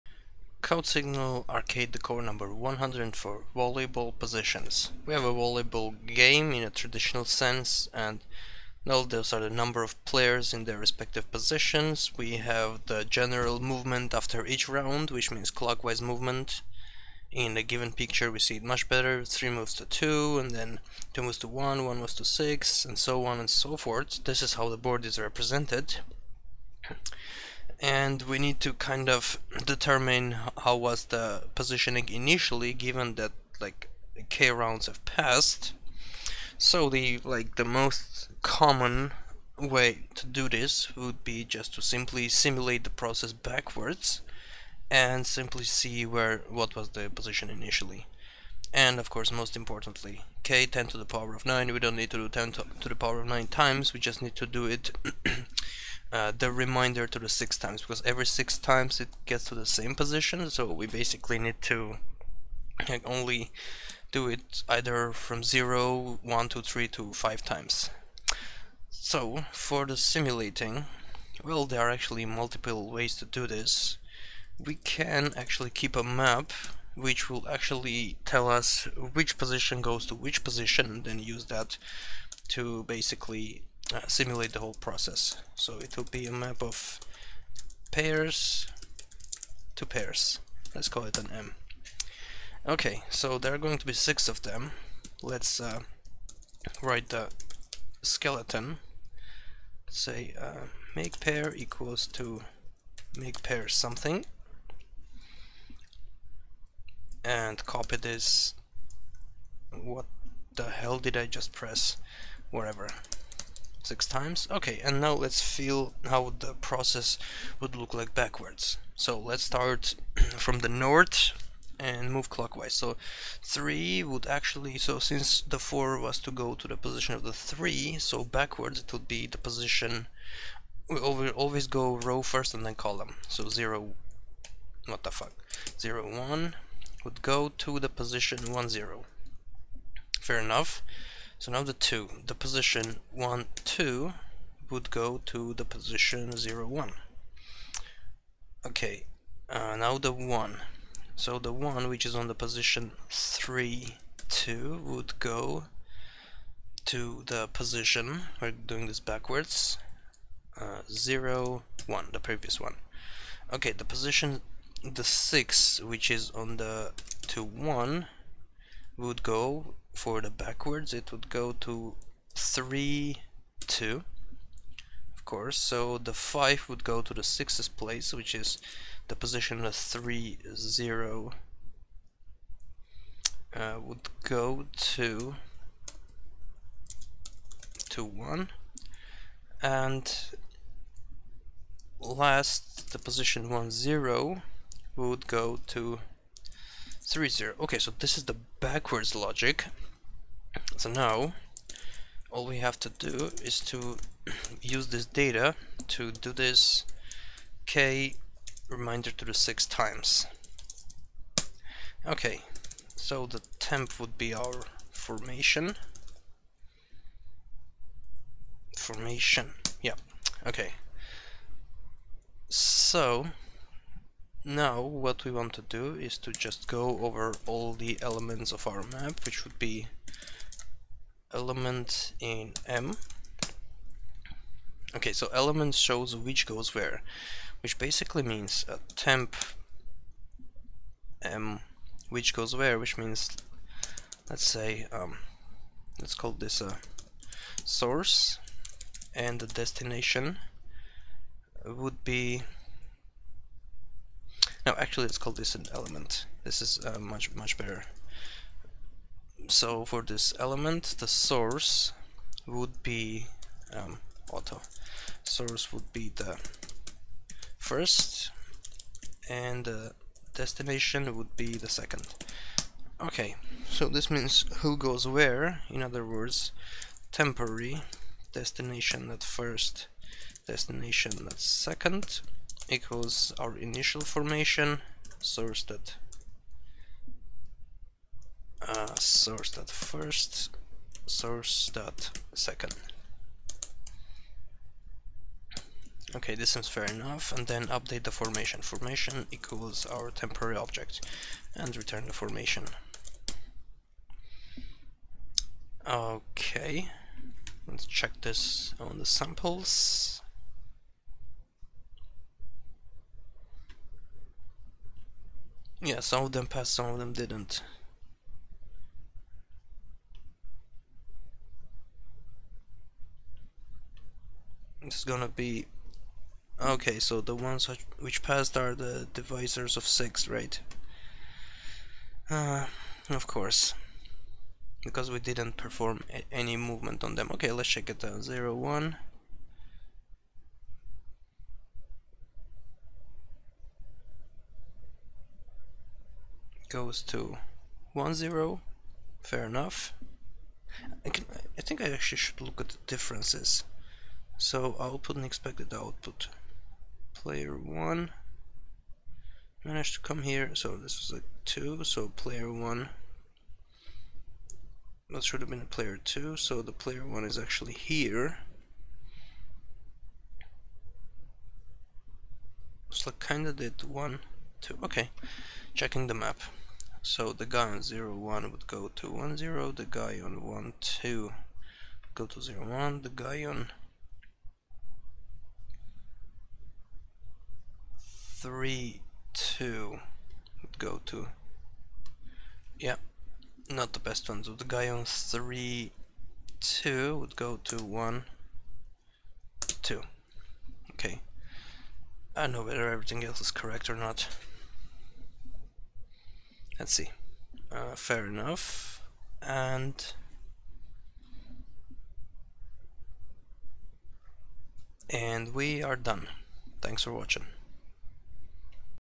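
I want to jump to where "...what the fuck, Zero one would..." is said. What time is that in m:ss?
2:14.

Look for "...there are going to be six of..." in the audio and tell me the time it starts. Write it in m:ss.
1:33.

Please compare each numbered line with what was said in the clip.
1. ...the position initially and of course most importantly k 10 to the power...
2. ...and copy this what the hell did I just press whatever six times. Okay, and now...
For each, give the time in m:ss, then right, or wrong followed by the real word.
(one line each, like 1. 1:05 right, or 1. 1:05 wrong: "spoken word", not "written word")
1. 0:46 right
2. 1:47 right.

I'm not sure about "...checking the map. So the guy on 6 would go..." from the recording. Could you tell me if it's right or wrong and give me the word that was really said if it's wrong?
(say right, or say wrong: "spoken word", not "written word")
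wrong: "1", not "6".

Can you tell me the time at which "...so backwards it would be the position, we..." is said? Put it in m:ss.
2:07.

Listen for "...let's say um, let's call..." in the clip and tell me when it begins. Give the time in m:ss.
4:04.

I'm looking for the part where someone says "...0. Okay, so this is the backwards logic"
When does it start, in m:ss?
3:17.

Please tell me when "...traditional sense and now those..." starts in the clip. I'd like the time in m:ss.
0:06.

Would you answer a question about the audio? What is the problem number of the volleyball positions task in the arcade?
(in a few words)
104.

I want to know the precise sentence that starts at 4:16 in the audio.
This is uh, much, much better.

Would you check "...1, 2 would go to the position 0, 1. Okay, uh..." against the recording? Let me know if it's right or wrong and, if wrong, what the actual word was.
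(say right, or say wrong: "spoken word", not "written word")
right.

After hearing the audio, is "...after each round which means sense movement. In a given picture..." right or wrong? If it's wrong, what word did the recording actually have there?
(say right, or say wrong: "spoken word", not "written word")
wrong: "clockwise", not "sense".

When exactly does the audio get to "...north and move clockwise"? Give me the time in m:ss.
2:00.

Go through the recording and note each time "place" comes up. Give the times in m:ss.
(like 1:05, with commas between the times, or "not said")
2:57.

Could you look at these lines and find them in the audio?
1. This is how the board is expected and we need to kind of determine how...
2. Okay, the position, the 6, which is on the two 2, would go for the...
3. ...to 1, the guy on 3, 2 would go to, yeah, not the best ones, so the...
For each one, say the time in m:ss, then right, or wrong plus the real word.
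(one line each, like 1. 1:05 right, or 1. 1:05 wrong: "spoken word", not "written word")
1. 0:24 wrong: "represented", not "expected"
2. 2:43 wrong: "1", not "2"
3. 6:22 right.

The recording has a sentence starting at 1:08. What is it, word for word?
So for the simulating, well there are actually multiple ways to do this.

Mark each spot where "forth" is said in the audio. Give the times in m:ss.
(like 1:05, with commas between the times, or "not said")
0:23.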